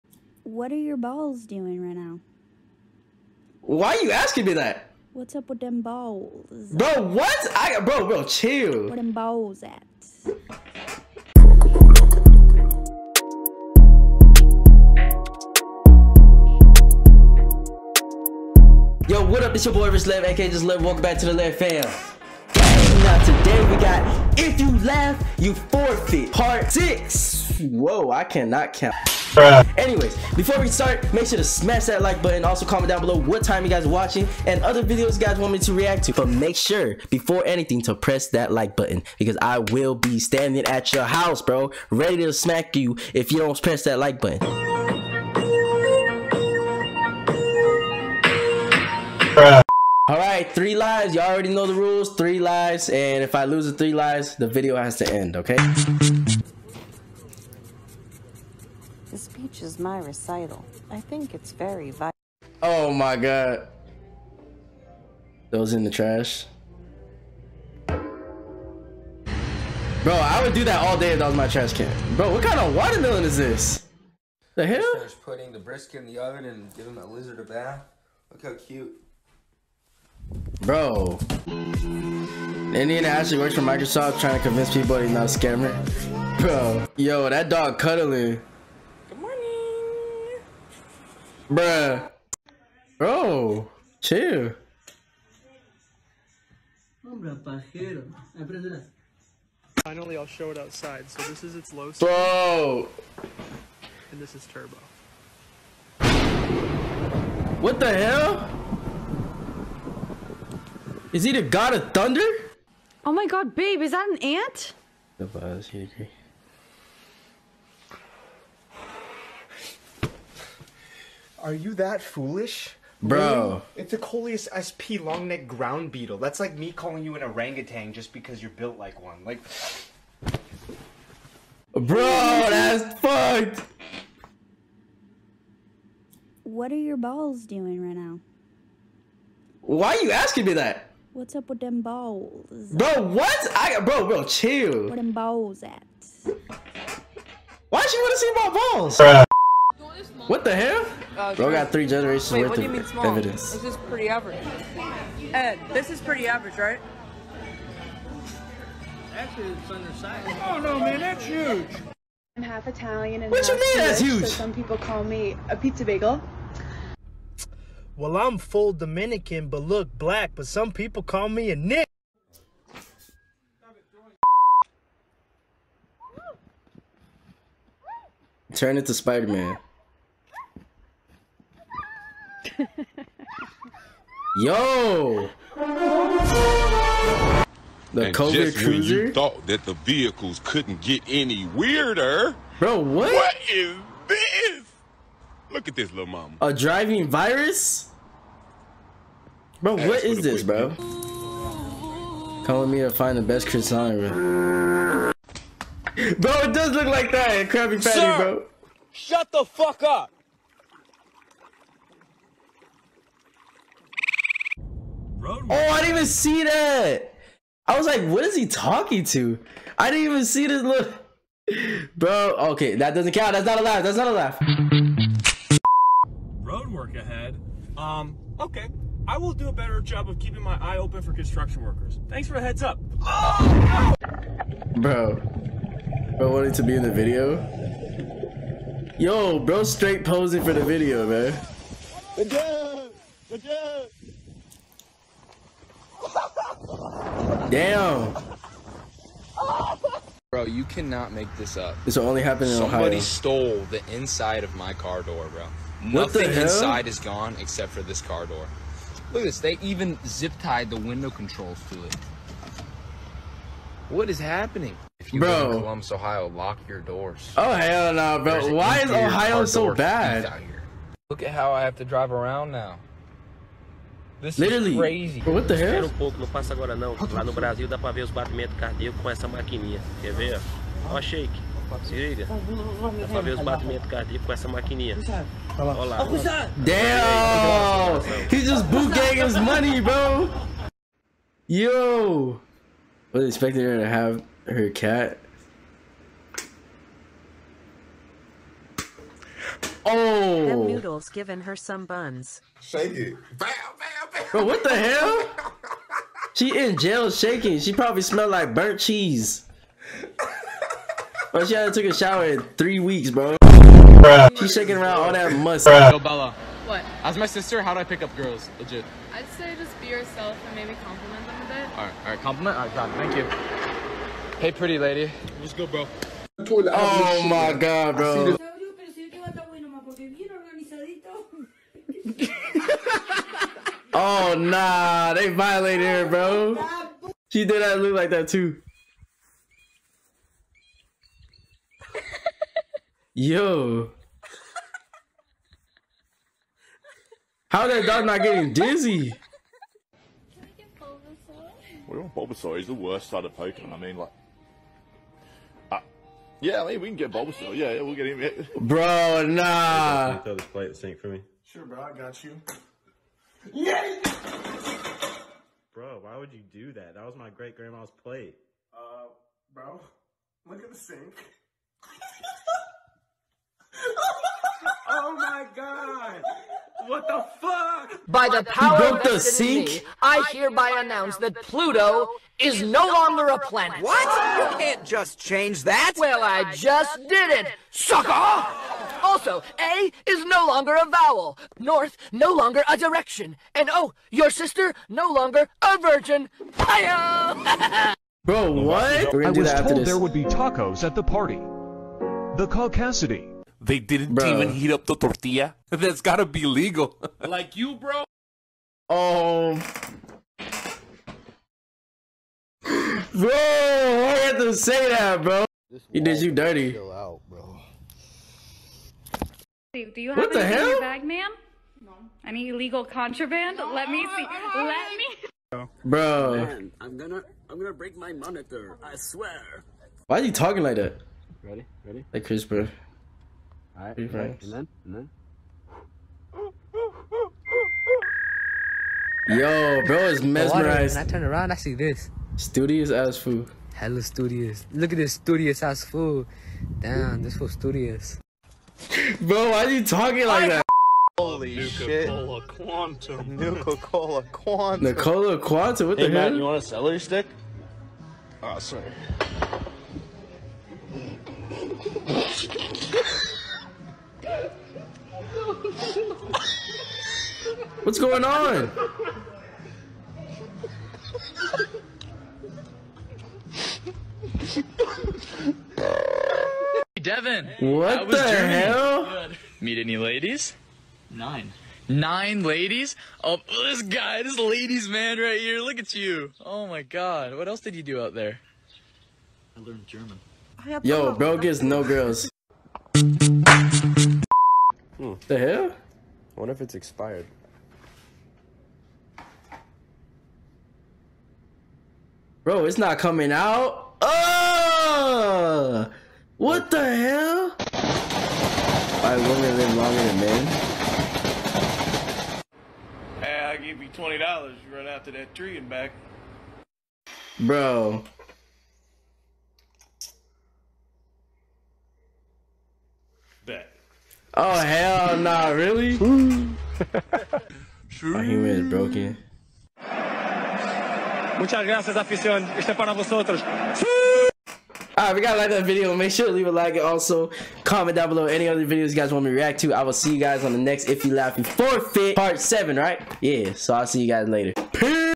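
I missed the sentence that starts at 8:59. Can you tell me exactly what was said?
I will see you guys on the next If You Laugh You Forfeit Part 7, right?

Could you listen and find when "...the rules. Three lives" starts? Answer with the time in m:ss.
0:51.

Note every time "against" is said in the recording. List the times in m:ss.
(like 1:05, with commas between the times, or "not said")
not said.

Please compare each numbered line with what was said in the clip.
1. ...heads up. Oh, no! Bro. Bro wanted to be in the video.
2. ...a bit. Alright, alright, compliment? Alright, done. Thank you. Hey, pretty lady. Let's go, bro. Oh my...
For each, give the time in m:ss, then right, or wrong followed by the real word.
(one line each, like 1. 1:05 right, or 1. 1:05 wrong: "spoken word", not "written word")
1. 3:52 right
2. 5:21 right.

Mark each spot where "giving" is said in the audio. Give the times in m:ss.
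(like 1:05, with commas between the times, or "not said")
1:16, 5:01.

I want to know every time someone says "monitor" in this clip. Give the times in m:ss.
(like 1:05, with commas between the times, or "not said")
7:08.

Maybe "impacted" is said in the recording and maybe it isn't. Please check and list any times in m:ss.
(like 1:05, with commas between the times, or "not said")
not said.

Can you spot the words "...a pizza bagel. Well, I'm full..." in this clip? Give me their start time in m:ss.
2:45.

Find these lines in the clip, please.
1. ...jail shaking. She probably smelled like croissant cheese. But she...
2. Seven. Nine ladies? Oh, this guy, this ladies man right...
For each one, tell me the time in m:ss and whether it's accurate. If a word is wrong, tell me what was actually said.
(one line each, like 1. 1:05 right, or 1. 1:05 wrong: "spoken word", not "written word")
1. 5:06 wrong: "burnt", not "croissant"
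2. 8:01 wrong: "Nine", not "Seven".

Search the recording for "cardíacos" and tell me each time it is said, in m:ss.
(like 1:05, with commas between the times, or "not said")
4:38, 4:43.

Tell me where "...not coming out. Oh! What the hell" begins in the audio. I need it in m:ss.
8:22.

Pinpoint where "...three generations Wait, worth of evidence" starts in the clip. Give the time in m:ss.
2:31.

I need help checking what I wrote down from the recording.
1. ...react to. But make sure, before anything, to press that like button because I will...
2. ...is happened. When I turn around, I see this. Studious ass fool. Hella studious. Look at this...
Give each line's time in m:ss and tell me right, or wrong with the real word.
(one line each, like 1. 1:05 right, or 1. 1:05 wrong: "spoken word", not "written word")
1. 0:35 right
2. 7:19 wrong: "mesmerized", not "happened".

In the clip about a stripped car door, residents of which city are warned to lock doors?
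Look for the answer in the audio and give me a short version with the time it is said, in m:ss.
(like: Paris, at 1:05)
Columbus, Ohio, at 4:25.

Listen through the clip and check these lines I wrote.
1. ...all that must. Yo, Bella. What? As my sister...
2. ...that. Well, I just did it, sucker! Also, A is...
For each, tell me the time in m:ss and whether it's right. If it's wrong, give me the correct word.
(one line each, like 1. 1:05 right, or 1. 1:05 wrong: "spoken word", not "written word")
1. 5:14 right
2. 6:25 right.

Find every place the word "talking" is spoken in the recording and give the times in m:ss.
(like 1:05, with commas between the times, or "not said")
3:38, 7:10, 7:29.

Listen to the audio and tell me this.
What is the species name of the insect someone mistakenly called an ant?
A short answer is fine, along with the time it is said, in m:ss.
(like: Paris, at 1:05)
Coleus SP long neck ground beetle, at 2:03.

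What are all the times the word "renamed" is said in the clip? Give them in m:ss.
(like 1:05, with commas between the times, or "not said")
not said.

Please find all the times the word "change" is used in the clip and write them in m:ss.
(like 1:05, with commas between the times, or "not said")
6:25.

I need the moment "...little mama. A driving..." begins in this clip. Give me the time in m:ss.
3:15.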